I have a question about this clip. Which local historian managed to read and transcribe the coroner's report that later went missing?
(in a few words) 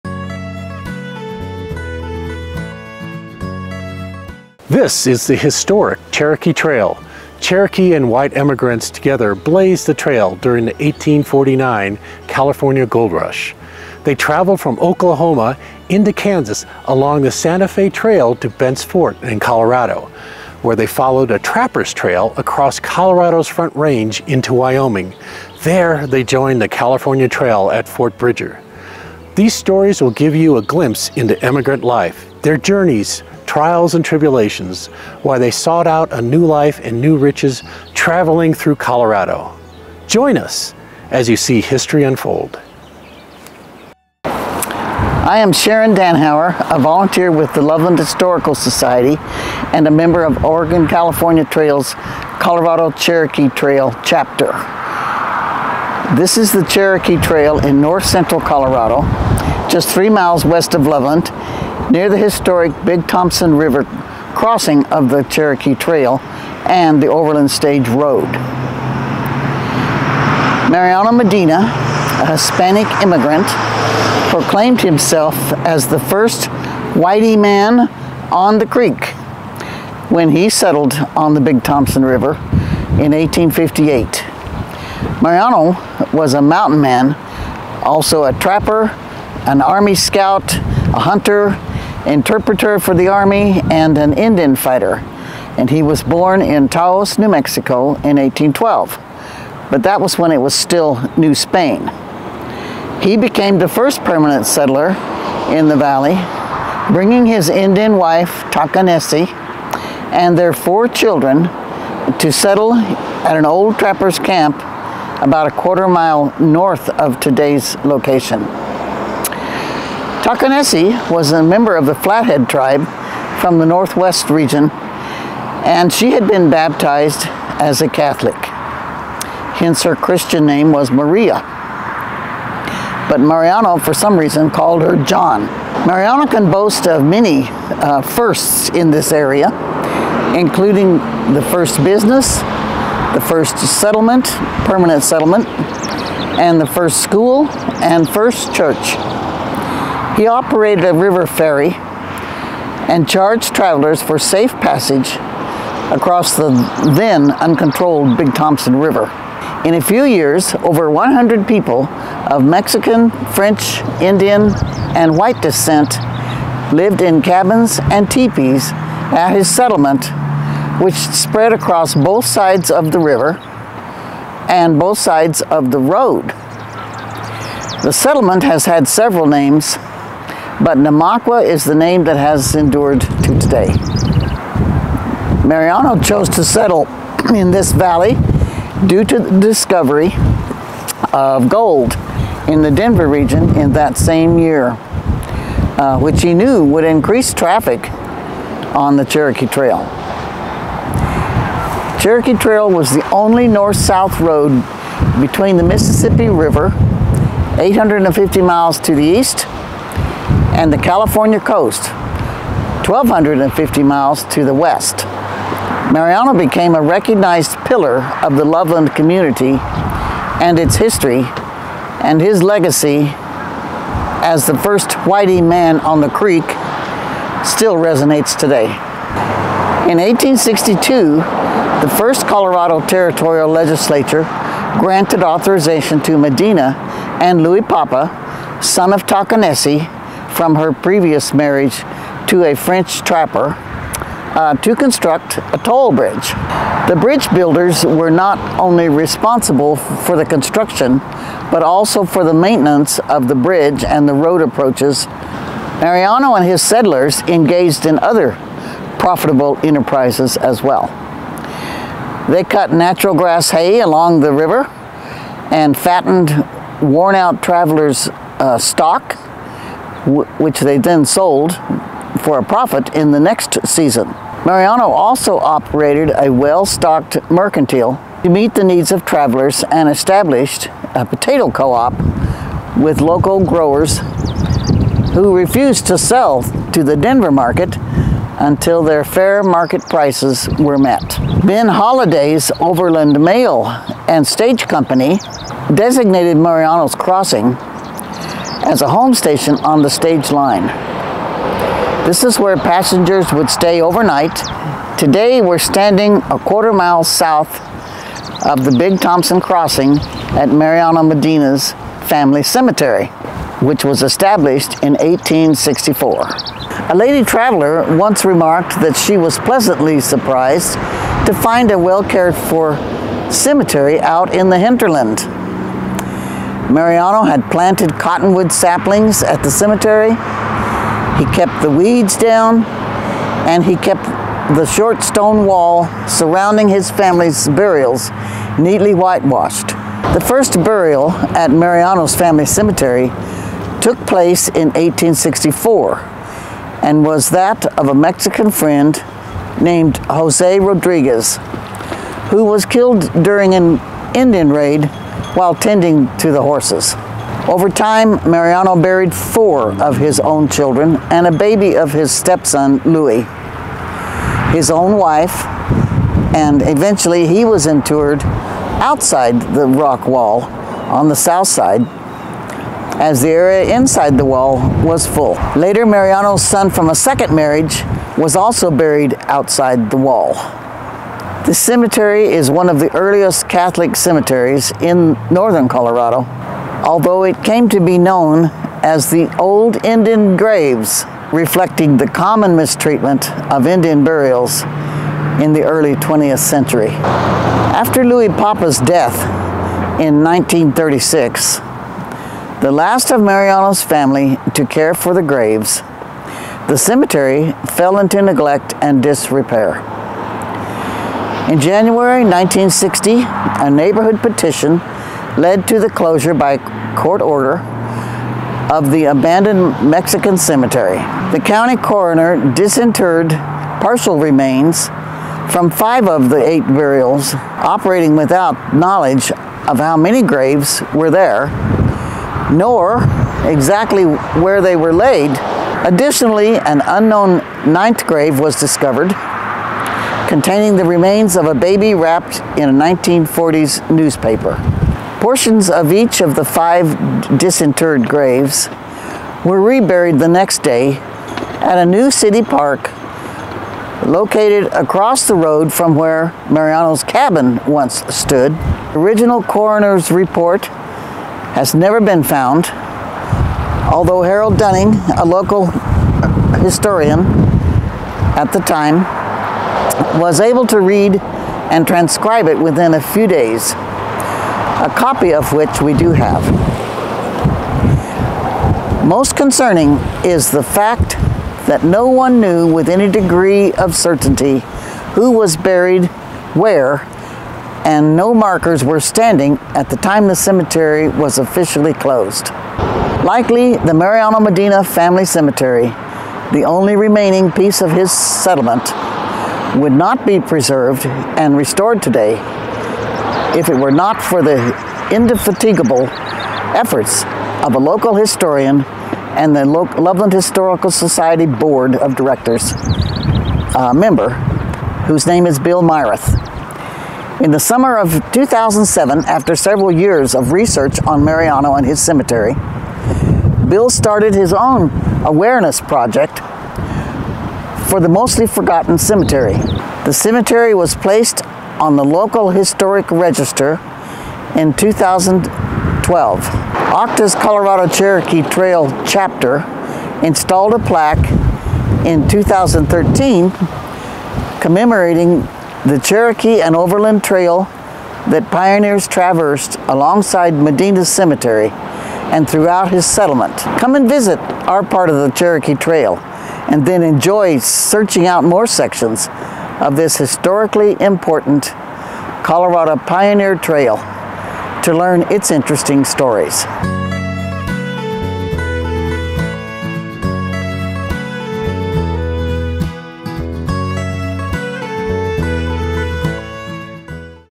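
Harold Dunning.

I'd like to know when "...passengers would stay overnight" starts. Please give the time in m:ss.
5:02.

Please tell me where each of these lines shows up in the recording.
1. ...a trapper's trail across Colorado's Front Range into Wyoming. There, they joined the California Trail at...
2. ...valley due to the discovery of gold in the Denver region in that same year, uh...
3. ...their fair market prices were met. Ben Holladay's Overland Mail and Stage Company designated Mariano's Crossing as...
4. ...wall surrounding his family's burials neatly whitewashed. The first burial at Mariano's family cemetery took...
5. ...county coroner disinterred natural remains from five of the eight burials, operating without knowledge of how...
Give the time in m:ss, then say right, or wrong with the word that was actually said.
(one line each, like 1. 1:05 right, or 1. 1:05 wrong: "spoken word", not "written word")
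1. 0:21 right
2. 3:07 right
3. 4:48 right
4. 5:35 right
5. 7:01 wrong: "partial", not "natural".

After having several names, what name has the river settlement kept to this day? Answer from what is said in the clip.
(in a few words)
Namaqua.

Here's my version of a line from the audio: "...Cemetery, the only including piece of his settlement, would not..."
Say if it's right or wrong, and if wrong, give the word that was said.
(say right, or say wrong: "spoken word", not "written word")
wrong: "remaining", not "including".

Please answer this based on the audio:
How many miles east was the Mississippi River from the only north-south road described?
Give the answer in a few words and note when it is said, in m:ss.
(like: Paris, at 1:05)
850, at 3:27.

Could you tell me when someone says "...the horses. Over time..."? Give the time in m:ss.
5:56.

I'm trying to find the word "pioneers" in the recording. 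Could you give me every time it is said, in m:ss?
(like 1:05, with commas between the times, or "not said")
9:08, 9:22.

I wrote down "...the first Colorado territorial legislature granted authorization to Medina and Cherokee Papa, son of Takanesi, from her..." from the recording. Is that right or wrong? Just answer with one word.
wrong.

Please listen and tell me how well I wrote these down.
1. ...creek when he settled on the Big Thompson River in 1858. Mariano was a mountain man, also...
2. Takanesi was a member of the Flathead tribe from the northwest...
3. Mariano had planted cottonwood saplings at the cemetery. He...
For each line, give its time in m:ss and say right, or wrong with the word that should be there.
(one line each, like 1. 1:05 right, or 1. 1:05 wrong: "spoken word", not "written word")
1. 1:18 right
2. 2:00 right
3. 5:26 right.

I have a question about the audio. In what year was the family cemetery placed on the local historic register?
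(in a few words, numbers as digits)
2012.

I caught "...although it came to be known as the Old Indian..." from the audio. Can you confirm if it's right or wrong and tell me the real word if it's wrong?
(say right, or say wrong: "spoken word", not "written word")
right.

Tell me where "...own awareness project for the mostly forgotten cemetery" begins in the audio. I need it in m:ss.
8:44.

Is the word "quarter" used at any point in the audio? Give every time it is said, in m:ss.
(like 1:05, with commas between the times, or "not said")
1:55, 5:06.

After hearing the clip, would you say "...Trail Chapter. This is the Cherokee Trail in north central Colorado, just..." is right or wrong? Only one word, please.
right.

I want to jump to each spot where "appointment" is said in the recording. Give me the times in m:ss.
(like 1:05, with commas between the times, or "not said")
not said.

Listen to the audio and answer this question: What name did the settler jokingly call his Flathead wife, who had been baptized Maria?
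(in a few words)
John.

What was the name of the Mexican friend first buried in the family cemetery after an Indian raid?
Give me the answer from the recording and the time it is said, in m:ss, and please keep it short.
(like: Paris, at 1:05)
Jose Rodriguez, at 5:50.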